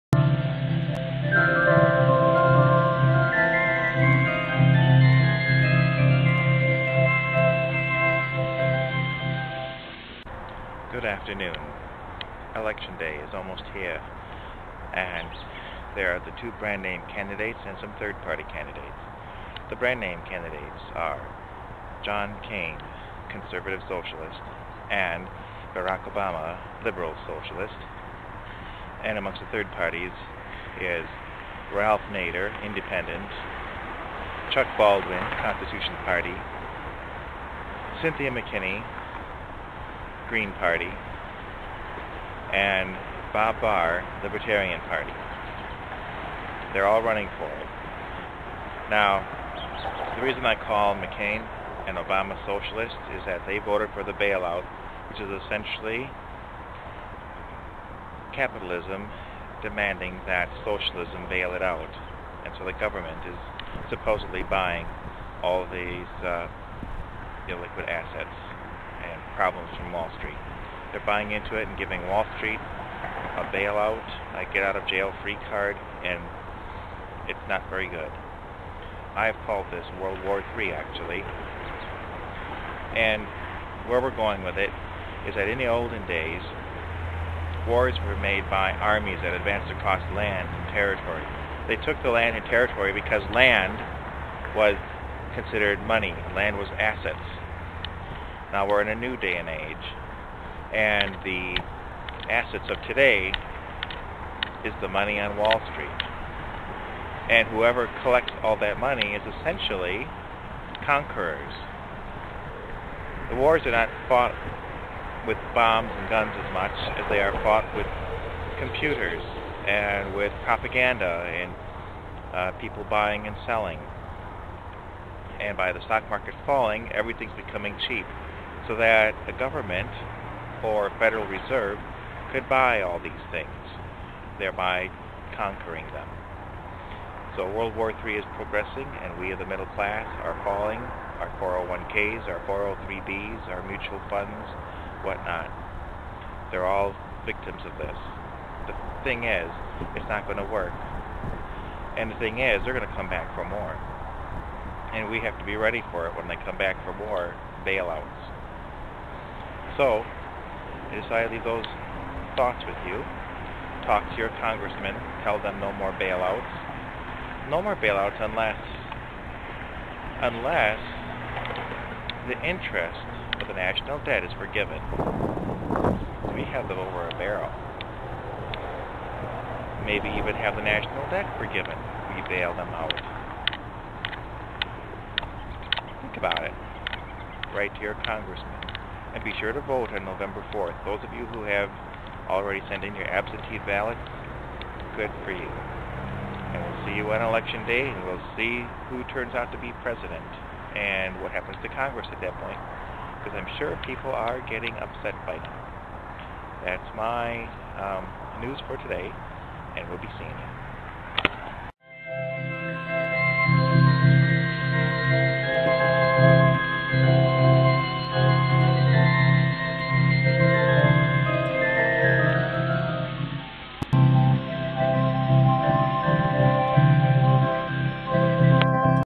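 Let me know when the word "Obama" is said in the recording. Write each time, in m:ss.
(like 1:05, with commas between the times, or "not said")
0:26, 0:51.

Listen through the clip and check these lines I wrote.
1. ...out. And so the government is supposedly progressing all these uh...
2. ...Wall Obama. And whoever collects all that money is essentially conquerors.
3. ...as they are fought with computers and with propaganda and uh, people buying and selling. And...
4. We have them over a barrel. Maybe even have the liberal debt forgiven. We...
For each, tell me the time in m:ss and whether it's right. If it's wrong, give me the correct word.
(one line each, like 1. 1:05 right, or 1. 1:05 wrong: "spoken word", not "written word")
1. 1:01 wrong: "buying", not "progressing"
2. 1:45 wrong: "Street", not "Obama"
3. 1:56 right
4. 2:56 wrong: "national", not "liberal".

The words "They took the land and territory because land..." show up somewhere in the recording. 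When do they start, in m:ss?
1:31.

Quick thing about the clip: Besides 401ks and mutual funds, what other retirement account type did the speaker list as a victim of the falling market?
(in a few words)
403b.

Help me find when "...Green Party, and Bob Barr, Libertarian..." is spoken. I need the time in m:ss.
0:40.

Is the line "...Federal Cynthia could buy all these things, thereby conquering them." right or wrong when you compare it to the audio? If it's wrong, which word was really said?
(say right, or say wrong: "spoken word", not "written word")
wrong: "Reserve", not "Cynthia".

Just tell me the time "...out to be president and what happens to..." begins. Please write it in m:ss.
3:19.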